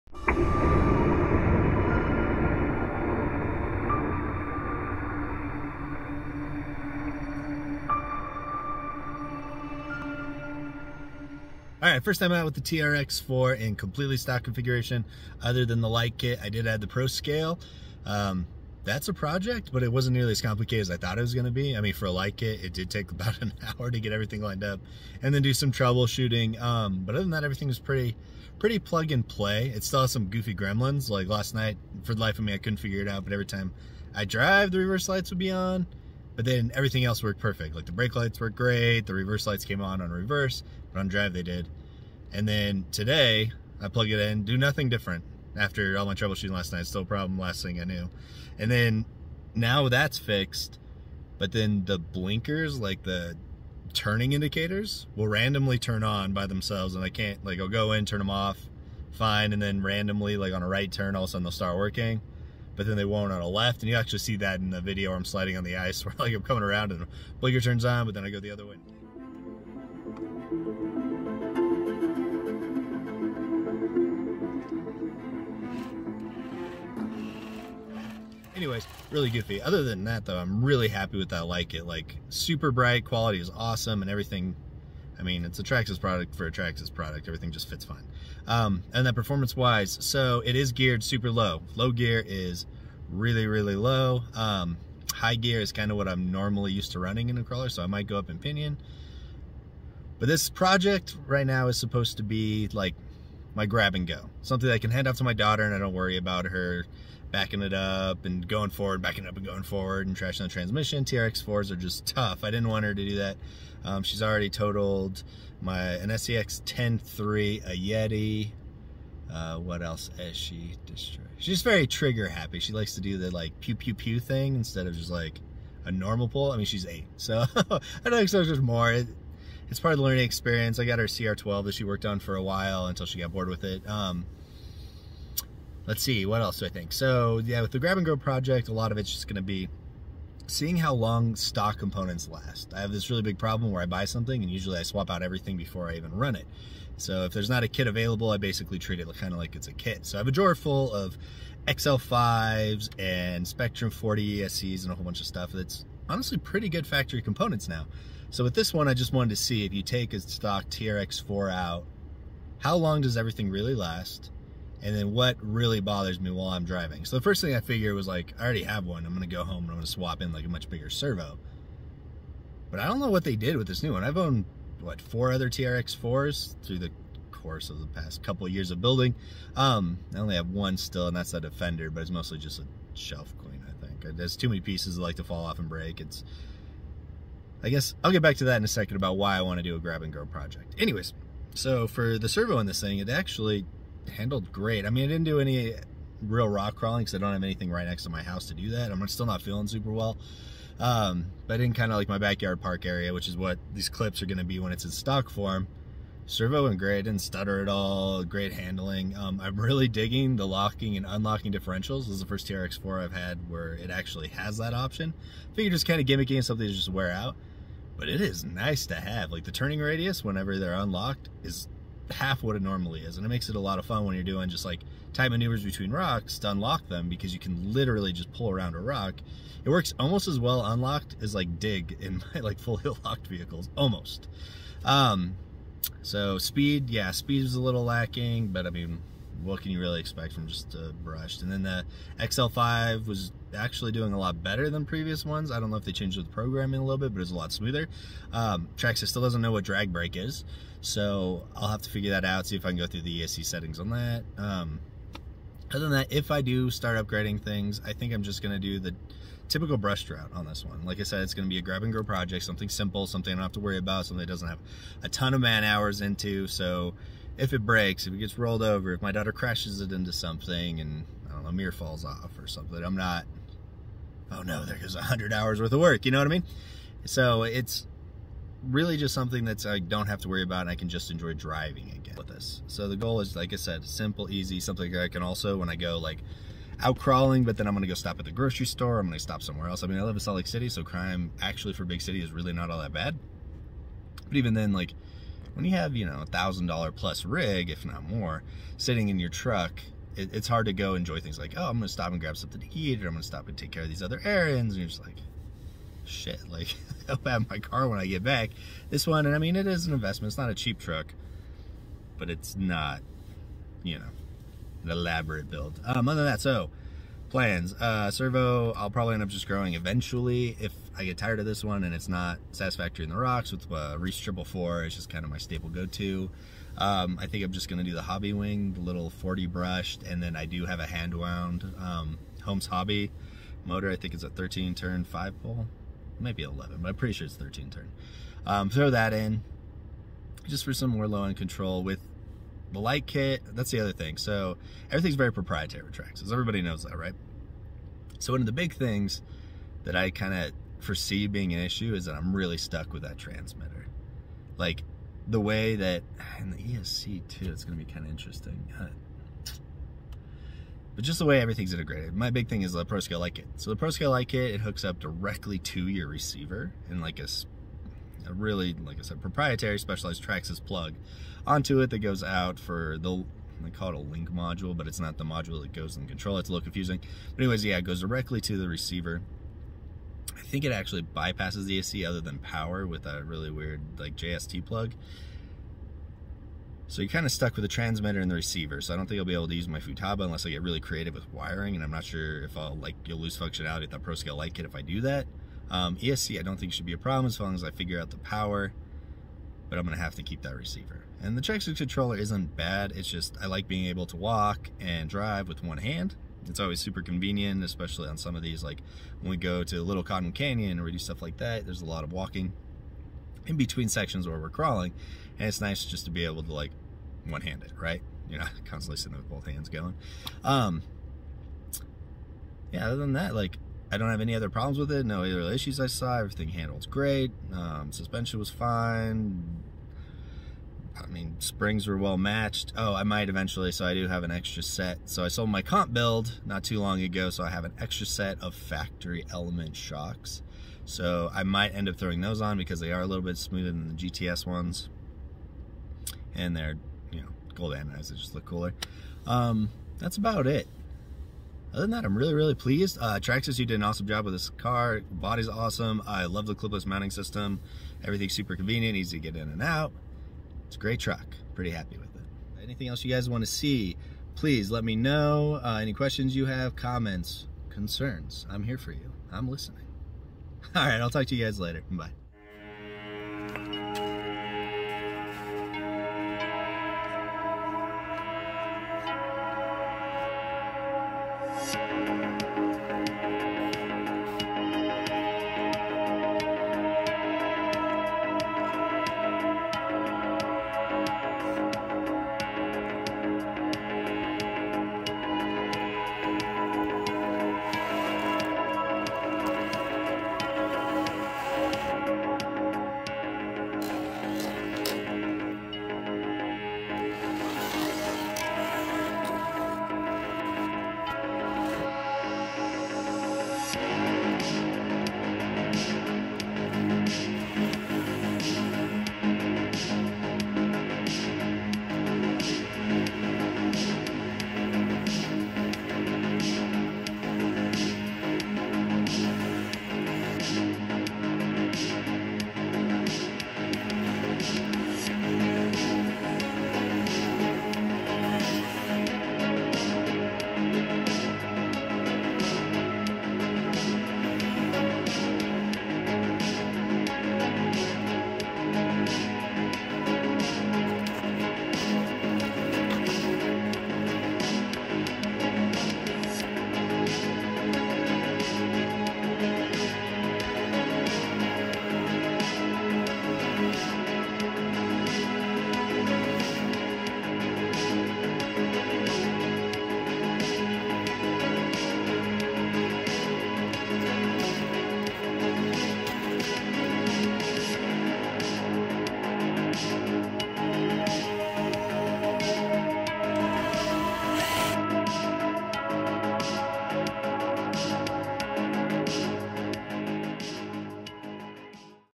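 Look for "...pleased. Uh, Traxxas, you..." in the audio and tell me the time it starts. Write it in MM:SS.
07:32.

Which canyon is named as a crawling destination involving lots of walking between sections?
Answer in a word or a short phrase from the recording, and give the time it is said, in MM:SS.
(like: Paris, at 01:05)
Little Cottonwood Canyon, at 06:49.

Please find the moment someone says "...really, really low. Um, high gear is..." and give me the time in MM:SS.
01:33.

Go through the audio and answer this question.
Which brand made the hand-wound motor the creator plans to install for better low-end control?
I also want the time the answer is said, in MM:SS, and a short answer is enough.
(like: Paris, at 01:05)
Holmes Hobby, at 05:32.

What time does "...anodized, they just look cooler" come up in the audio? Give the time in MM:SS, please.
07:27.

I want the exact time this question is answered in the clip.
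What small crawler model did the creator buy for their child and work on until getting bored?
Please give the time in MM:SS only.
02:11.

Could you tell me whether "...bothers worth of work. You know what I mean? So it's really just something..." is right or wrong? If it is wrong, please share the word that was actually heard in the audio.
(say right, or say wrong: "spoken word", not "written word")
wrong: "hours", not "bothers".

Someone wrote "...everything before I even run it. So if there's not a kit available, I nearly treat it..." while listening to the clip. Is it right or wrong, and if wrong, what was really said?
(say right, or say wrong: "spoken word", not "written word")
wrong: "basically", not "nearly".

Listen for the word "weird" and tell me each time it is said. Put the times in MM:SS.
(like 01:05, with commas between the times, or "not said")
06:23.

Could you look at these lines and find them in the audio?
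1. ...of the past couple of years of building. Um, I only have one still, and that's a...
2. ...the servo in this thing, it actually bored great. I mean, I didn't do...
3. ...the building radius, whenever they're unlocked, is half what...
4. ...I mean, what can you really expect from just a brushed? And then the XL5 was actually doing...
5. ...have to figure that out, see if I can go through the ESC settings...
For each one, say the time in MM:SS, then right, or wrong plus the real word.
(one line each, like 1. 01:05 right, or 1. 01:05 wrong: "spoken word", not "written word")
1. 02:57 right
2. 03:12 wrong: "handled", not "bored"
3. 03:39 wrong: "turning", not "building"
4. 03:58 right
5. 04:11 right.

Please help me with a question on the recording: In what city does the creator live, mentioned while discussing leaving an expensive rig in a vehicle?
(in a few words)
Salt Lake City.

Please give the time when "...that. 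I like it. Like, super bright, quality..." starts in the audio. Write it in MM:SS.
01:21.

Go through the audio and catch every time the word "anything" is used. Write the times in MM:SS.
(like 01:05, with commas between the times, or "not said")
03:17, 07:42.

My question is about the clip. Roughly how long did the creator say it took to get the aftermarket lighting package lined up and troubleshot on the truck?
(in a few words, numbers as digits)
about an hour.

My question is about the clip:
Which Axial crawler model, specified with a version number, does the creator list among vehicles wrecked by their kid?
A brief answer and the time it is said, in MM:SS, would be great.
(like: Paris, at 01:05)
SCX10.3, at 01:56.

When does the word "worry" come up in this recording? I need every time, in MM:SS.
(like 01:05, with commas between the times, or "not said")
01:45, 04:23, 04:40.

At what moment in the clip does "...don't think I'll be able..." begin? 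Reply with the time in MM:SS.
06:28.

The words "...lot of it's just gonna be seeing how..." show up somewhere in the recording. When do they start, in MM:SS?
02:18.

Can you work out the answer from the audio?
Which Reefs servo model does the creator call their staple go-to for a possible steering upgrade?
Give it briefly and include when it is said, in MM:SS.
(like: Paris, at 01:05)
Triple Four, at 05:24.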